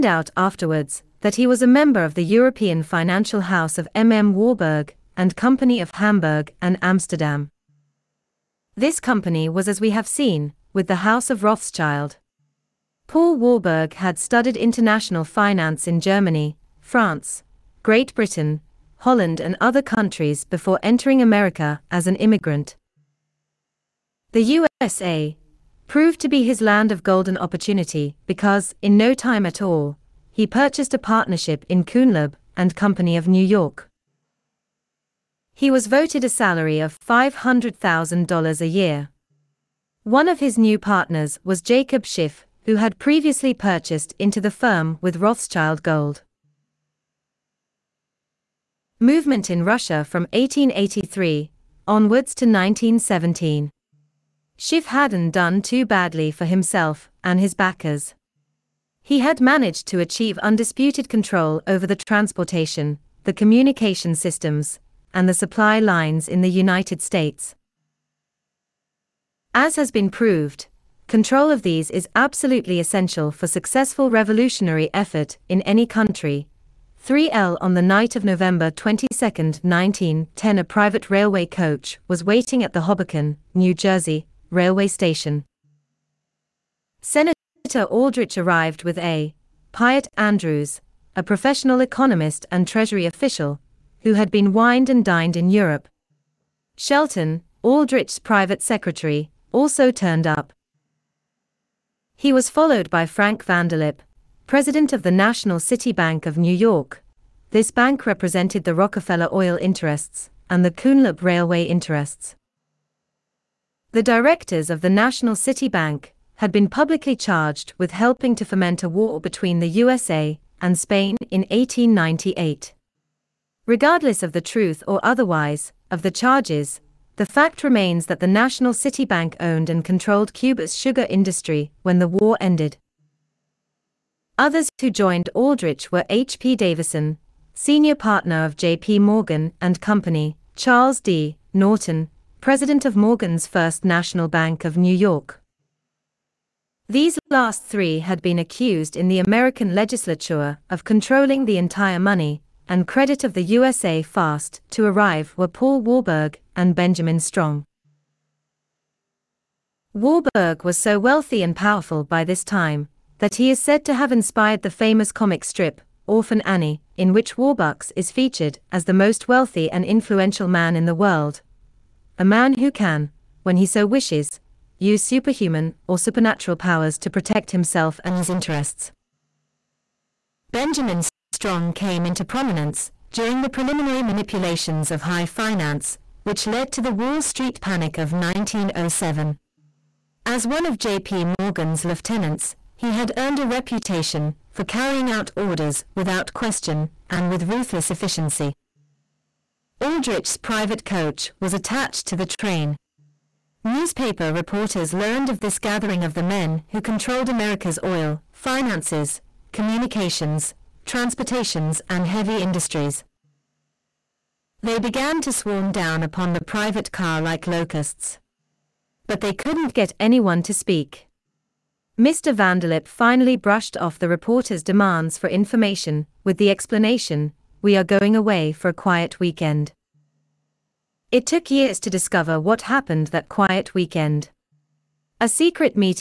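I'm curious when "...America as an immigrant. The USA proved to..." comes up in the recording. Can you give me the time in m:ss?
0:21.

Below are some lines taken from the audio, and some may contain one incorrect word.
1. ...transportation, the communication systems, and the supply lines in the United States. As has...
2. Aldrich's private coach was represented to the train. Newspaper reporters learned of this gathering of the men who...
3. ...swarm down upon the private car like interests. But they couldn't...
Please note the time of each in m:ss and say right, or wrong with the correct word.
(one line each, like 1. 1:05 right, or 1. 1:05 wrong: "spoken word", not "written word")
1. 1:01 right
2. 3:19 wrong: "attached", not "represented"
3. 3:35 wrong: "locusts", not "interests".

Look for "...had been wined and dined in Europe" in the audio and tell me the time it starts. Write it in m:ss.
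1:34.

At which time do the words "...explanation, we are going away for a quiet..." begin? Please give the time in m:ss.
3:46.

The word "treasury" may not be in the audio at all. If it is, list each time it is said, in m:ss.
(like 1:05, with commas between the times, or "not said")
1:32.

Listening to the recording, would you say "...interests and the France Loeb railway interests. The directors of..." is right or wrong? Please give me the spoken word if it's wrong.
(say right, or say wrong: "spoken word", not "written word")
wrong: "Kuhn", not "France".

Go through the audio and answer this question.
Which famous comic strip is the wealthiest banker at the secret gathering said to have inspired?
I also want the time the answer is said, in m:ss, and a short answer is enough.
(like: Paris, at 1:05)
Orphan Annie, at 2:46.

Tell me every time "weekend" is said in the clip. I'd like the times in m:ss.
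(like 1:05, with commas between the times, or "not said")
3:49, 3:53.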